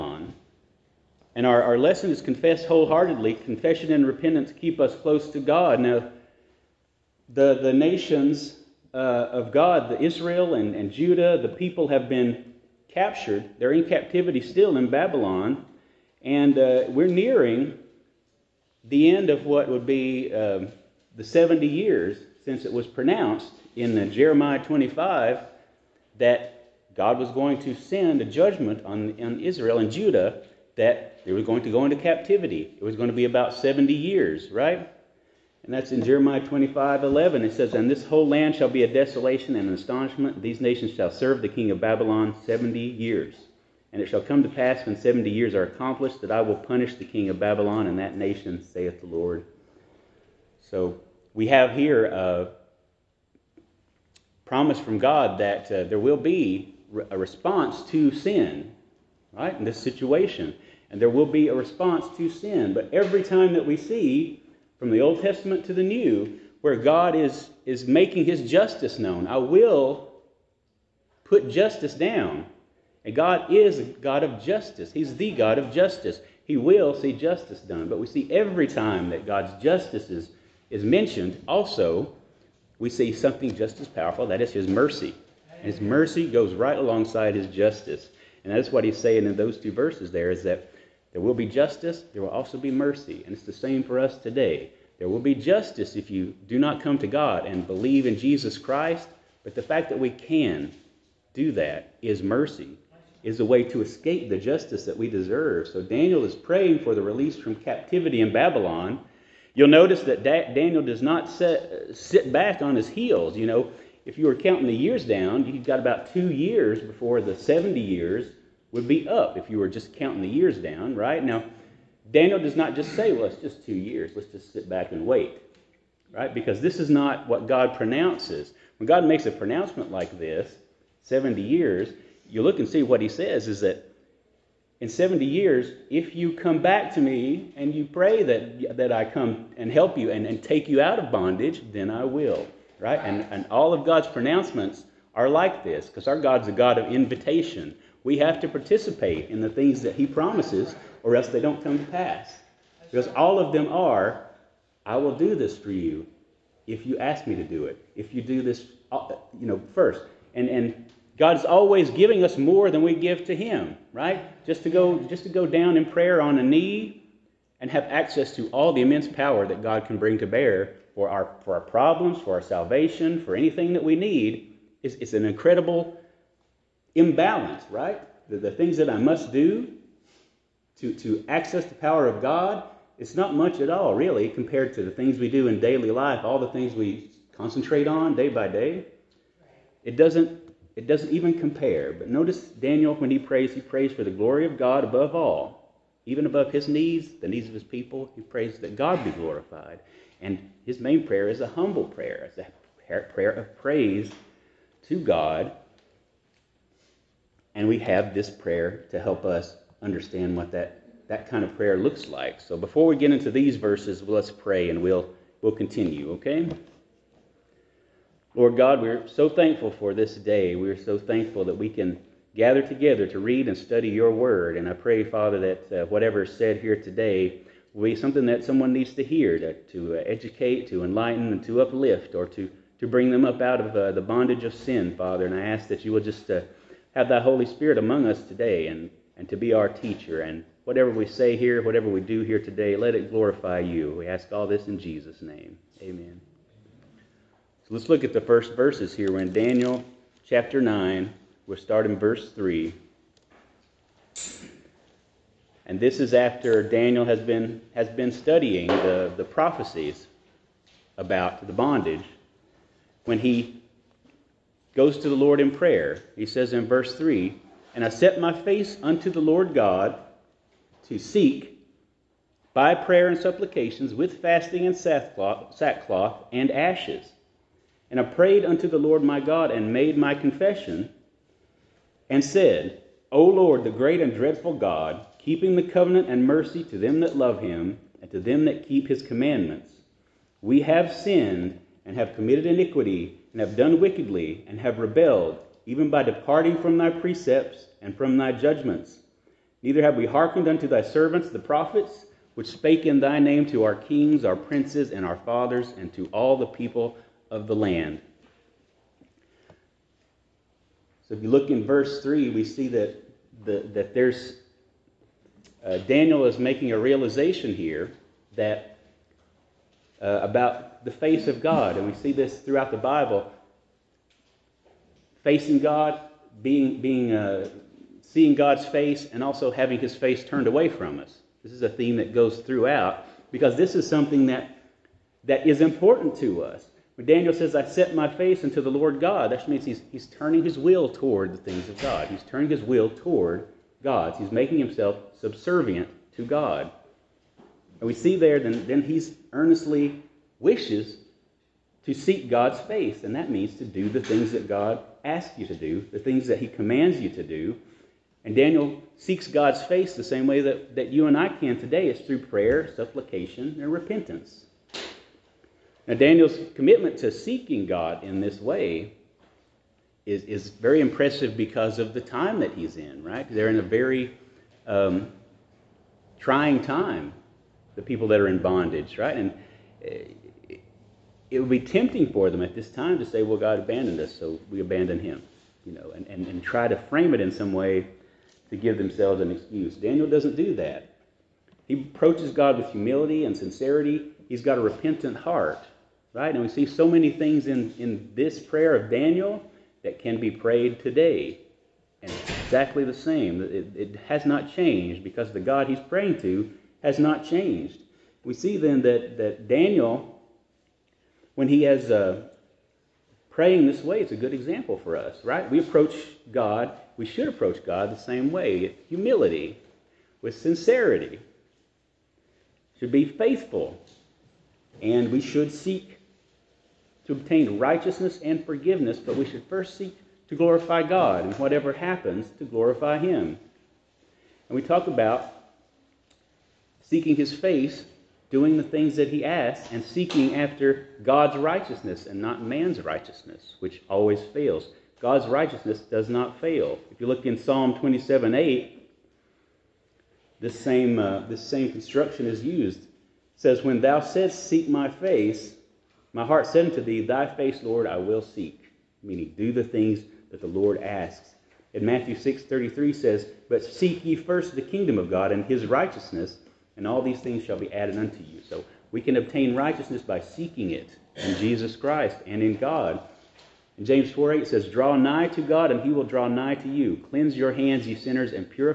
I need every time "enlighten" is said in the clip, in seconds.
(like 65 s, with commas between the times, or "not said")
230 s.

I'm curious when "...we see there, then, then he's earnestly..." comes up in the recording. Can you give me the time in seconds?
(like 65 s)
347 s.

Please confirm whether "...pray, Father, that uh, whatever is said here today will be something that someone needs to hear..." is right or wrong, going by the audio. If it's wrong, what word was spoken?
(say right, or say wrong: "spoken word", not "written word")
right.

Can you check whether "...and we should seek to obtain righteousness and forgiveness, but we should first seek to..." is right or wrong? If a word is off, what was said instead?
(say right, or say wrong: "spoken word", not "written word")
right.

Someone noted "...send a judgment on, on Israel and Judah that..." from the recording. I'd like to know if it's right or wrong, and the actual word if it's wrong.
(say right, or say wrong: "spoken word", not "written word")
right.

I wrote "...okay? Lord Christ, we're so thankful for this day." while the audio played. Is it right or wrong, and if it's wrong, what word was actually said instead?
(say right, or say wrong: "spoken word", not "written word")
wrong: "God", not "Christ".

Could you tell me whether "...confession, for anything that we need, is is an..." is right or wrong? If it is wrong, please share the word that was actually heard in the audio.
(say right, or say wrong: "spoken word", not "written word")
wrong: "salvation", not "confession".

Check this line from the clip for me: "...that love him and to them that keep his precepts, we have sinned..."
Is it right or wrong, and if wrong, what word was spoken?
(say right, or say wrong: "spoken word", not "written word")
wrong: "commandments", not "precepts".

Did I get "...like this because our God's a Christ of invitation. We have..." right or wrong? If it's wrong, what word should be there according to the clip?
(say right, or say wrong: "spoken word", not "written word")
wrong: "God", not "Christ".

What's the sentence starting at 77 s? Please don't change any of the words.
But we see every time that God's justice is is mentioned, also, we see something just as powerful that is his mercy.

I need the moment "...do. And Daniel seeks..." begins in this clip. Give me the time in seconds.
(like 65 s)
357 s.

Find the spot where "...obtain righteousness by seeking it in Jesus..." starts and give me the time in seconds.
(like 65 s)
469 s.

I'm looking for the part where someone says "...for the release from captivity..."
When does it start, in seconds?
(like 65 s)
106 s.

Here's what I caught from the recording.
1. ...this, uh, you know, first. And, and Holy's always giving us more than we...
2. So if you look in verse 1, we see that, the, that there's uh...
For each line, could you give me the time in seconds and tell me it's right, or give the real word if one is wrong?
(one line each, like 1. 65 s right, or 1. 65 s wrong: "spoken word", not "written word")
1. 158 s wrong: "God", not "Holy"
2. 311 s wrong: "3", not "1".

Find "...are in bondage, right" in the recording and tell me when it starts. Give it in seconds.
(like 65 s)
378 s.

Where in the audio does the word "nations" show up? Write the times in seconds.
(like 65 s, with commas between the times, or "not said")
7 s, 40 s, 48 s.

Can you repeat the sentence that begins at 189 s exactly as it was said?
It doesn't it doesn't even compare.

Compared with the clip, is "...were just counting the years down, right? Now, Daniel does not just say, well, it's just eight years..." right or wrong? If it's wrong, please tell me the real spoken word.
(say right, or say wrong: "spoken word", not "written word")
wrong: "two", not "eight".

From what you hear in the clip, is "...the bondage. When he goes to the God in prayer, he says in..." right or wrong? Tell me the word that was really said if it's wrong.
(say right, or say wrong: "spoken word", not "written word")
wrong: "Lord", not "God".